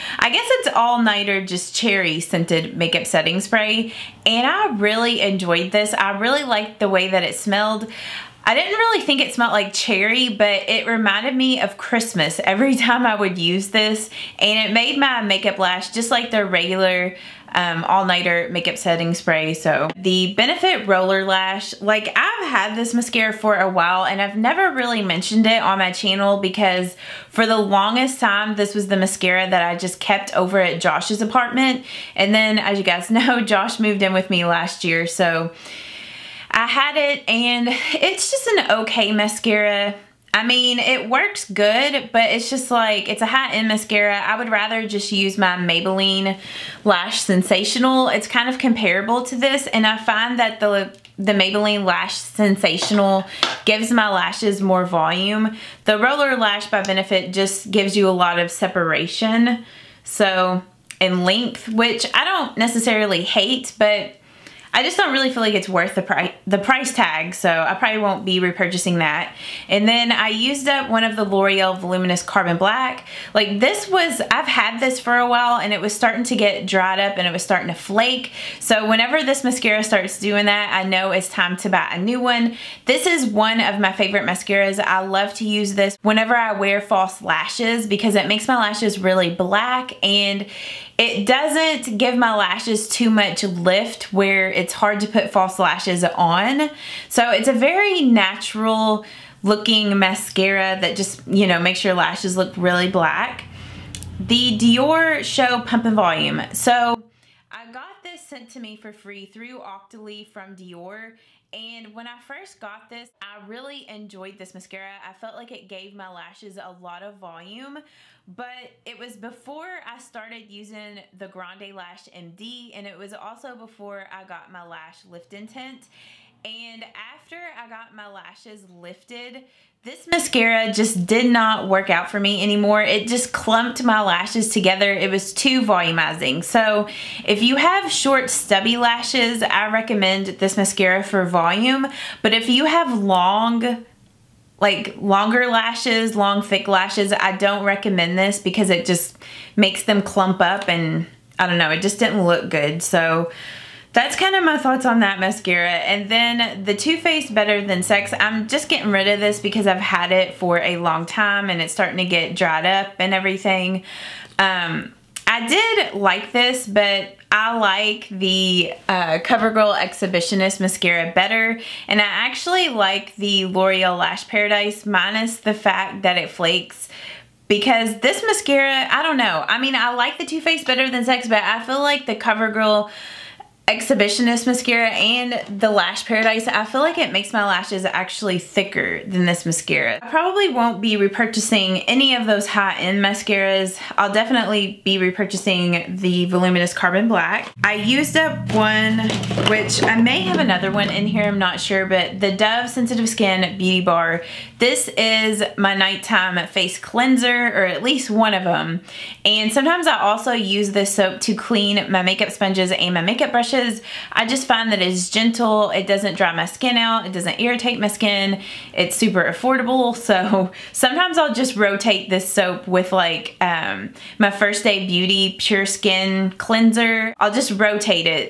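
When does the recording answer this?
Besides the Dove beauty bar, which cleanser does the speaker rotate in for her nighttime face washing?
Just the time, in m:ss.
3:44.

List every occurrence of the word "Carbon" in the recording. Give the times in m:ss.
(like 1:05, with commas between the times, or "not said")
1:12, 3:16.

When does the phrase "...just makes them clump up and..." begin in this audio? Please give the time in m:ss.
2:28.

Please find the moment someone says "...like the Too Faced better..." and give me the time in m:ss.
2:59.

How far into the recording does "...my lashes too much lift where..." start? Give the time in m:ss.
1:32.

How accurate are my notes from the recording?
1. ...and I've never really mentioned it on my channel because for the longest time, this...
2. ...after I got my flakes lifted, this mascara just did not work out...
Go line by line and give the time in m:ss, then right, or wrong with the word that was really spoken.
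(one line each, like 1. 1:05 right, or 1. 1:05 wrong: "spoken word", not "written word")
1. 0:24 right
2. 2:06 wrong: "lashes", not "flakes".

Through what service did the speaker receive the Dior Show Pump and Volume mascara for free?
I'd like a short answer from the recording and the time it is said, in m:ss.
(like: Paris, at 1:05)
Octoly, at 1:49.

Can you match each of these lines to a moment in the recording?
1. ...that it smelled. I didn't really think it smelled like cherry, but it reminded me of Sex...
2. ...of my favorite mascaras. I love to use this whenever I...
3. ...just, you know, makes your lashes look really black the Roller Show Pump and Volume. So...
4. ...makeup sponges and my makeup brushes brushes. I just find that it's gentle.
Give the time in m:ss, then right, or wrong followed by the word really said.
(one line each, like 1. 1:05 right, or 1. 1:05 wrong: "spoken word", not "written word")
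1. 0:07 wrong: "Christmas", not "Sex"
2. 1:23 right
3. 1:40 wrong: "Dior", not "Roller"
4. 3:32 right.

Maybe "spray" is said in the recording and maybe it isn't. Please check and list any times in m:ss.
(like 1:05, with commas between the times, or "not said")
0:03, 0:19.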